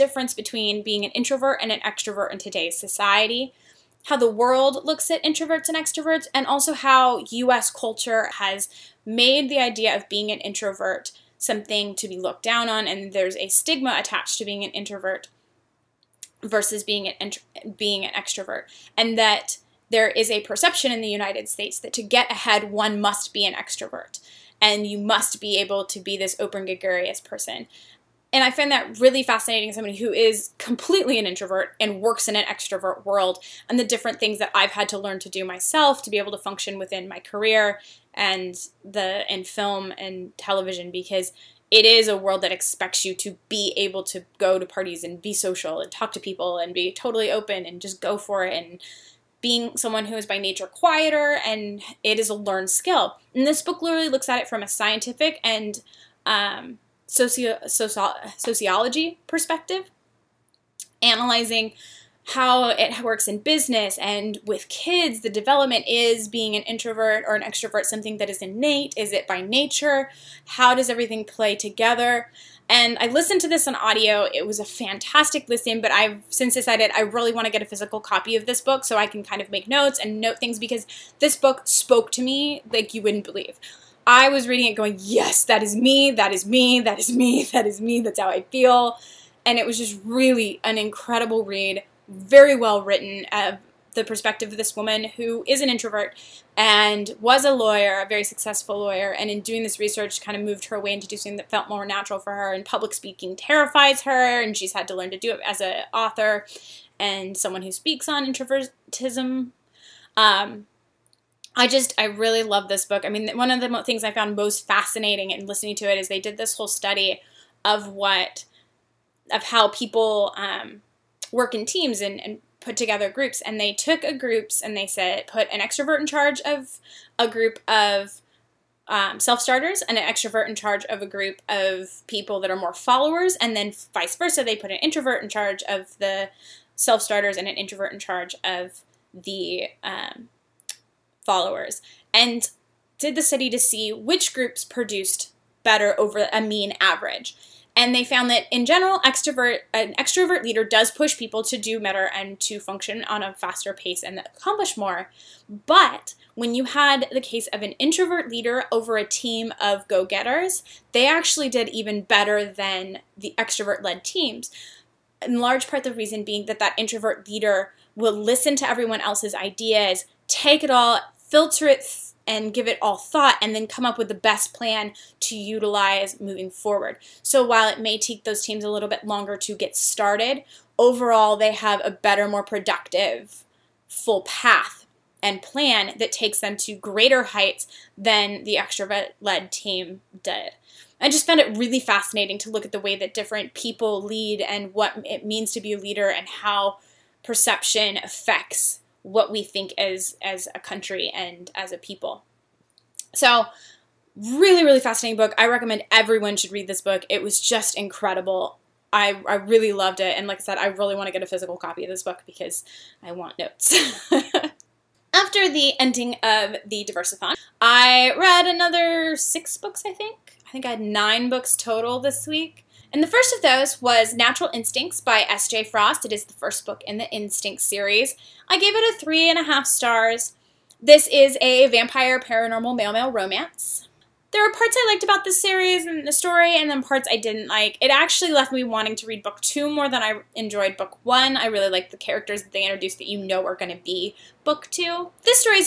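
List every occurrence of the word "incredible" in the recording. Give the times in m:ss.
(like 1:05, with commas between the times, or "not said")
1:30, 3:27.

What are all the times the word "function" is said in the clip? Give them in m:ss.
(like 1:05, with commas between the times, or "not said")
0:36, 2:32.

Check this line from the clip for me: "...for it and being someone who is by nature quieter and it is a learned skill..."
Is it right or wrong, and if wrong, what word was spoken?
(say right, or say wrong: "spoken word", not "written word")
right.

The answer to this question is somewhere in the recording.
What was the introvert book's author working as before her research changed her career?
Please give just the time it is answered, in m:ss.
1:37.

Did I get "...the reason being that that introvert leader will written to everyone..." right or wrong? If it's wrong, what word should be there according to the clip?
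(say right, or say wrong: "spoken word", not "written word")
wrong: "listen", not "written".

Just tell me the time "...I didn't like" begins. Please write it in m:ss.
3:57.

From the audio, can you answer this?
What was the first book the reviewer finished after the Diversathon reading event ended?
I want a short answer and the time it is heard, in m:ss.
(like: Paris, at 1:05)
Natural Instincts, at 3:44.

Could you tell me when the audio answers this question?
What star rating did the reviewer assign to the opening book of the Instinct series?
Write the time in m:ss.
3:48.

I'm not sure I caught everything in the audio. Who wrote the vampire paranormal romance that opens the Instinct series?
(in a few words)
S.J. Frost.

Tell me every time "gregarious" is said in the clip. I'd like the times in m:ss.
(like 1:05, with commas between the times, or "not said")
0:26.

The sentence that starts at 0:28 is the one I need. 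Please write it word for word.
And I find that really fascinating.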